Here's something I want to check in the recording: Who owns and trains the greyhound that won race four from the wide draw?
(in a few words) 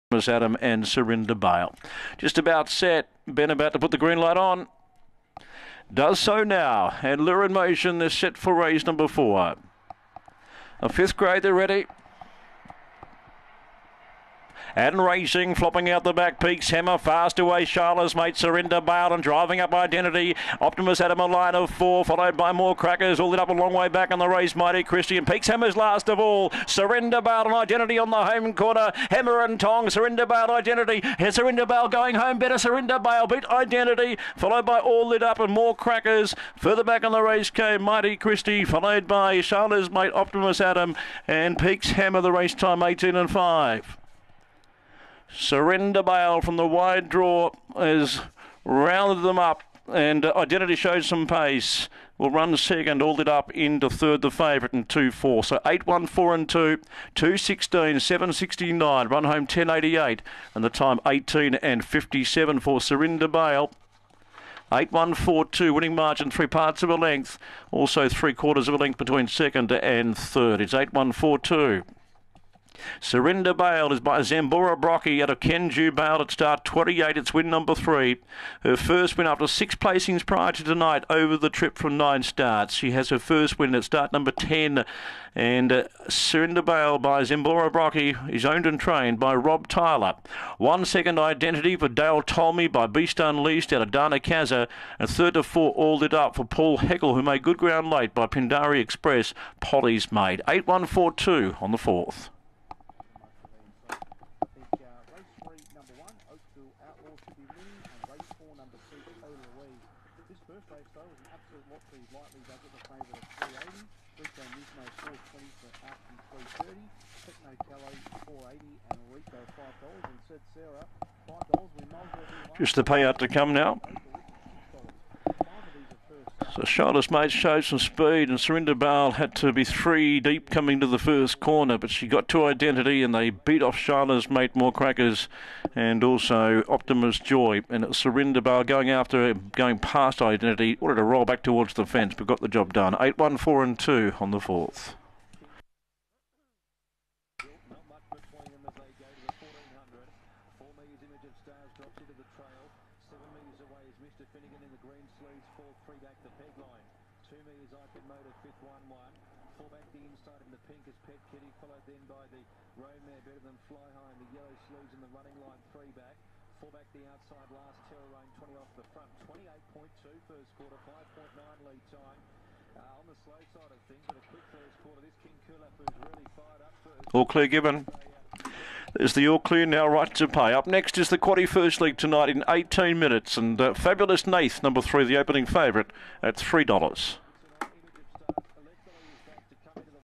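Rob Tyler.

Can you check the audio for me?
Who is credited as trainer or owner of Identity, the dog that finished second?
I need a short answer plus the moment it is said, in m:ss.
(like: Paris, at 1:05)
Dale Tolmy, at 1:31.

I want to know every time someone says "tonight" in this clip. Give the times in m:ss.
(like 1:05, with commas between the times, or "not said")
1:20, 3:01.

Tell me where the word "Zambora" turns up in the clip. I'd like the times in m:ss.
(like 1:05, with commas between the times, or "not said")
1:14, 1:27.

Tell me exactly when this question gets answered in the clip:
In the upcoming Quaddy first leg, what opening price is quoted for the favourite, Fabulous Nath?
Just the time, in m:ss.
3:06.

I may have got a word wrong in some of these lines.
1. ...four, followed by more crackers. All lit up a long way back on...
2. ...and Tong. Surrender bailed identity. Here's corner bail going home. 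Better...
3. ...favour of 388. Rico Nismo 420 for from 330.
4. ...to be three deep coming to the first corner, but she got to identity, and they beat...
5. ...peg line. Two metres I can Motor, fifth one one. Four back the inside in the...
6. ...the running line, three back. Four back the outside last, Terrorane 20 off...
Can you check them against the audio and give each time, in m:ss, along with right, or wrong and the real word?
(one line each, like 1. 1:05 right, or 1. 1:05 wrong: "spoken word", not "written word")
1. 0:21 right
2. 0:29 wrong: "surrender", not "corner"
3. 1:52 wrong: "380", not "388"
4. 2:09 right
5. 2:36 right
6. 2:45 right.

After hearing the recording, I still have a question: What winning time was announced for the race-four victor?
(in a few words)
18.57.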